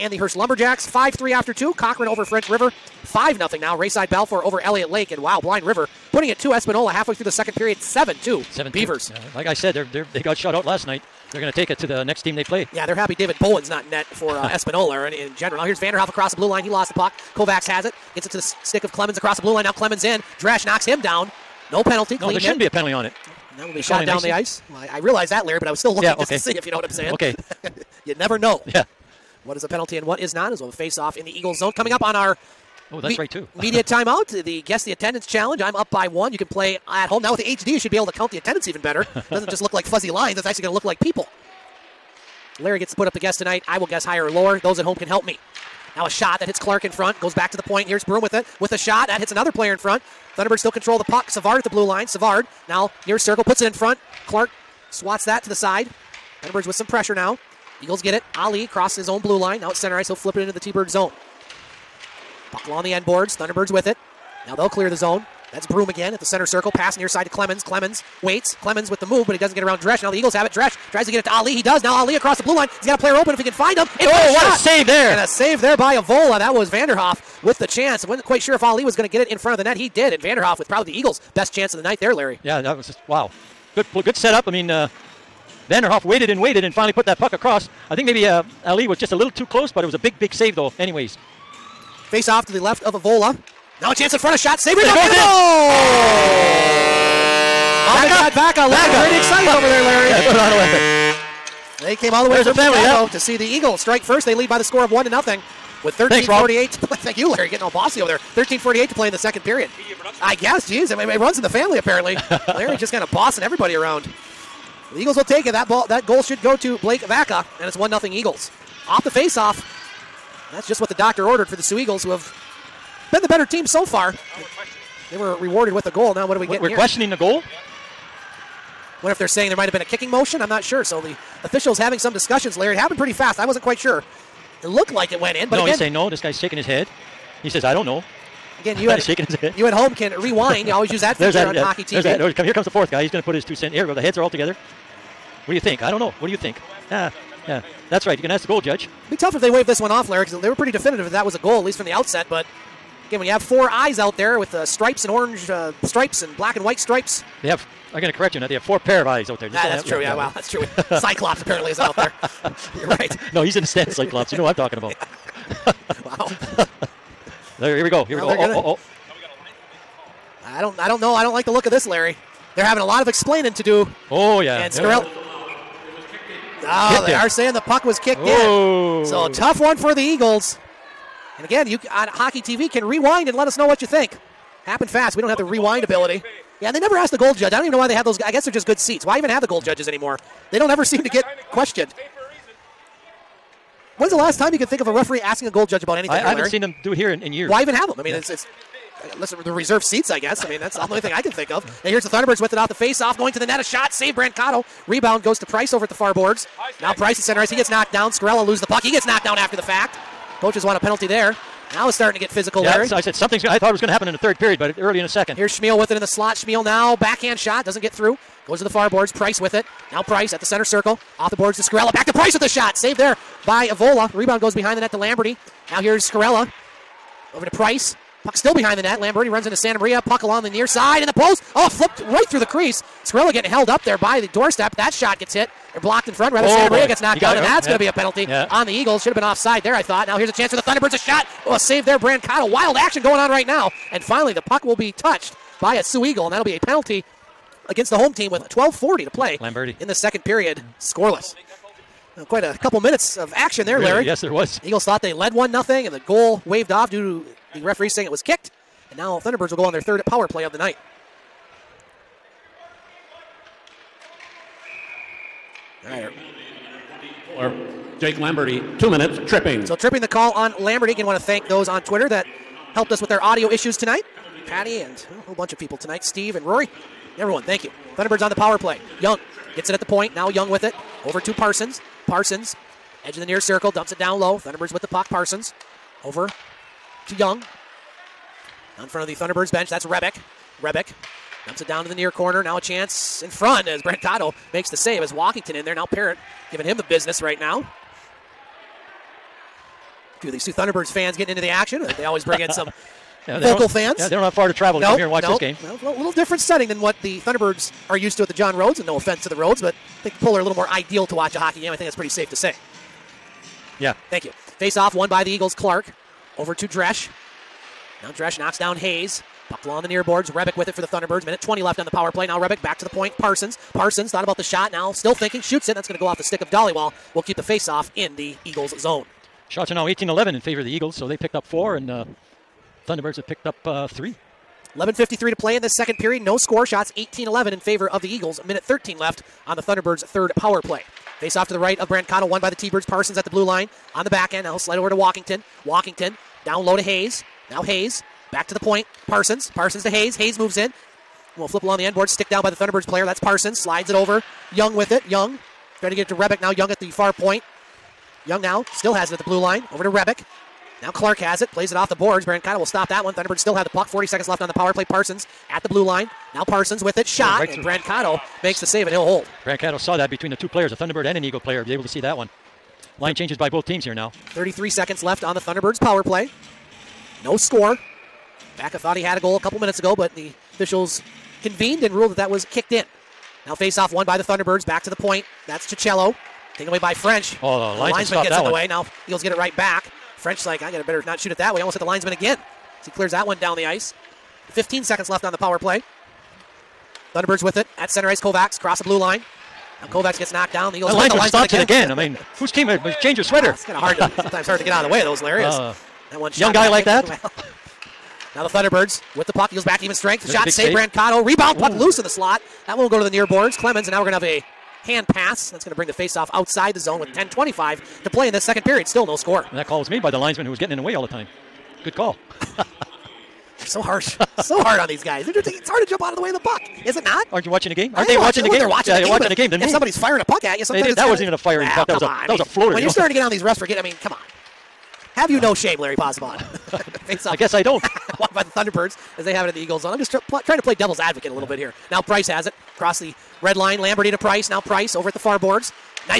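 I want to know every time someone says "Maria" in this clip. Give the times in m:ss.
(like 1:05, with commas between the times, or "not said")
3:49, 3:56.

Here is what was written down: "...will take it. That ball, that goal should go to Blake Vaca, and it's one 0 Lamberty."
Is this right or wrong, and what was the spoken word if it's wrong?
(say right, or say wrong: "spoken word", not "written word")
wrong: "Eagles", not "Lamberty".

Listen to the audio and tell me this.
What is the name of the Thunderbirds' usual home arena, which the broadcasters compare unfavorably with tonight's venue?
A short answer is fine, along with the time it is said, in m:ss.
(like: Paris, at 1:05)
John Rhodes, at 5:08.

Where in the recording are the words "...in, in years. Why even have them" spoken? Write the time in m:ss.
3:17.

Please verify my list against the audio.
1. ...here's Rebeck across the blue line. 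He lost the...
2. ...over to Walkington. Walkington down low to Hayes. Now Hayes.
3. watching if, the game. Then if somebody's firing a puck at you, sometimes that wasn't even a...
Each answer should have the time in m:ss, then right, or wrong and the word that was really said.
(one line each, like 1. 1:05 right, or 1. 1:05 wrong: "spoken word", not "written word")
1. 0:15 wrong: "Vanderhoff", not "Rebeck"
2. 5:44 right
3. 7:09 right.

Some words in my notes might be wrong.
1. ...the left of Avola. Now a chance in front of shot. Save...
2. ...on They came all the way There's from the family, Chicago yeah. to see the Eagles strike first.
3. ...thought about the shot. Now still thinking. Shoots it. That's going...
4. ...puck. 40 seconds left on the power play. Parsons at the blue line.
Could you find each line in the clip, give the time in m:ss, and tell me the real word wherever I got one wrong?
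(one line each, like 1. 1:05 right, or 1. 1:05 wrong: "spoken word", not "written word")
1. 1:32 right
2. 1:41 right
3. 5:24 right
4. 6:03 right.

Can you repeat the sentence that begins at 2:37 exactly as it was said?
I'm going to correct you on that.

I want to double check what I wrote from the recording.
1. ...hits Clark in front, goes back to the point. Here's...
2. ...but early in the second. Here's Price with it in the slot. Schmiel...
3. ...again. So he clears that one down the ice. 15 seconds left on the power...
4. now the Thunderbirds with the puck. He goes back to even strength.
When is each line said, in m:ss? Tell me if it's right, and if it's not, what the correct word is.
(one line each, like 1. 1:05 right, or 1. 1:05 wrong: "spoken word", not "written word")
1. 0:46 right
2. 3:34 wrong: "Schmiel", not "Price"
3. 6:32 right
4. 6:48 right.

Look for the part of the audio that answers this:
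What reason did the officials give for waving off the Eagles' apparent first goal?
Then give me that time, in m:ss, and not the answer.
2:57.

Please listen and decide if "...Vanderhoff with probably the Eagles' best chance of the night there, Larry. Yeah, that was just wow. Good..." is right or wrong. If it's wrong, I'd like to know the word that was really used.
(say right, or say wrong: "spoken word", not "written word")
right.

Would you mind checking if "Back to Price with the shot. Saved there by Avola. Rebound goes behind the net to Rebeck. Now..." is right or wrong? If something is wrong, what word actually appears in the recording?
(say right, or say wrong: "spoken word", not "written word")
wrong: "Lamberty", not "Rebeck".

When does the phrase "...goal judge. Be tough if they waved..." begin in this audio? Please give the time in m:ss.
2:28.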